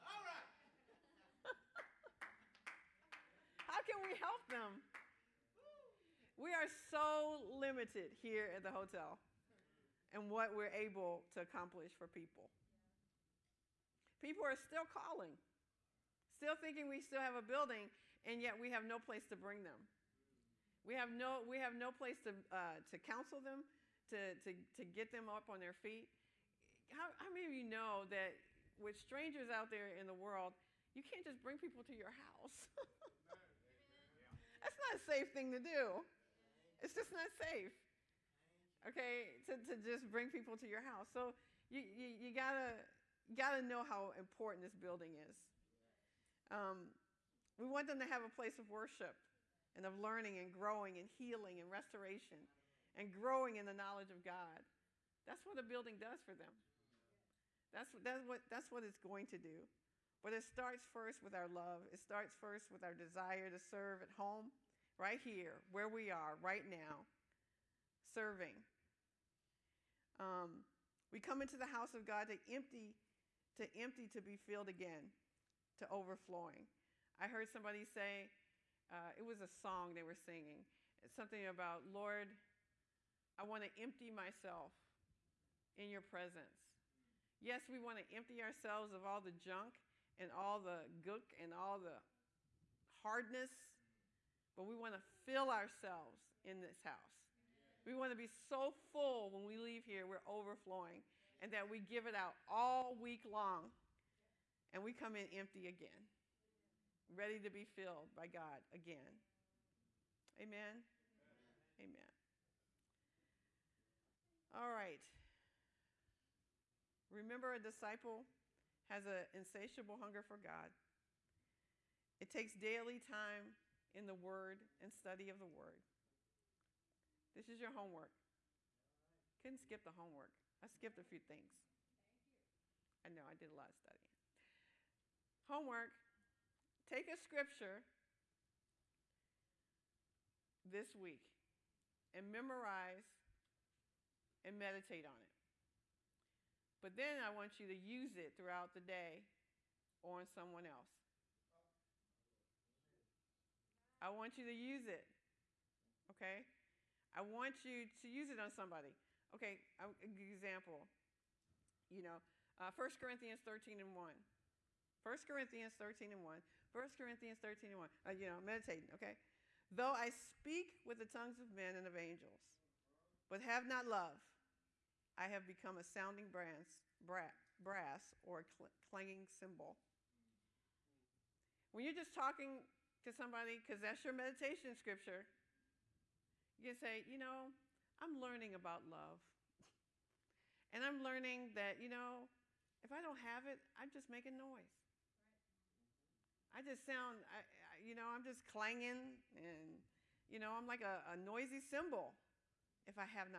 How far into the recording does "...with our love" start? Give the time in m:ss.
1:01.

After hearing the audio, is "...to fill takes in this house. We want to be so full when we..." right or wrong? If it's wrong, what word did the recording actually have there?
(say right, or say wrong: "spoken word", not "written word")
wrong: "ourselves", not "takes".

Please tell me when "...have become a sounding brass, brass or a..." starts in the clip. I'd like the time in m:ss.
2:55.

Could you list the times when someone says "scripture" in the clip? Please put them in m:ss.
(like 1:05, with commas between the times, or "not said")
2:17, 3:04.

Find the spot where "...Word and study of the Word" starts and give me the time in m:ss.
2:04.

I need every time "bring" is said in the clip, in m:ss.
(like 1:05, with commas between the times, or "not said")
0:19, 0:31, 0:40.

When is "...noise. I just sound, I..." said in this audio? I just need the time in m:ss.
3:14.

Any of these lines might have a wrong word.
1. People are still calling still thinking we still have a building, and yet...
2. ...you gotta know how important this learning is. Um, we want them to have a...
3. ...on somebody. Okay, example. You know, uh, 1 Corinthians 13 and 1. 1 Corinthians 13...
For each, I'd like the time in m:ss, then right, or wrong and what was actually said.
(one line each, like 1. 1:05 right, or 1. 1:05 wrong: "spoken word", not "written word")
1. 0:14 right
2. 0:43 wrong: "building", not "learning"
3. 2:38 right.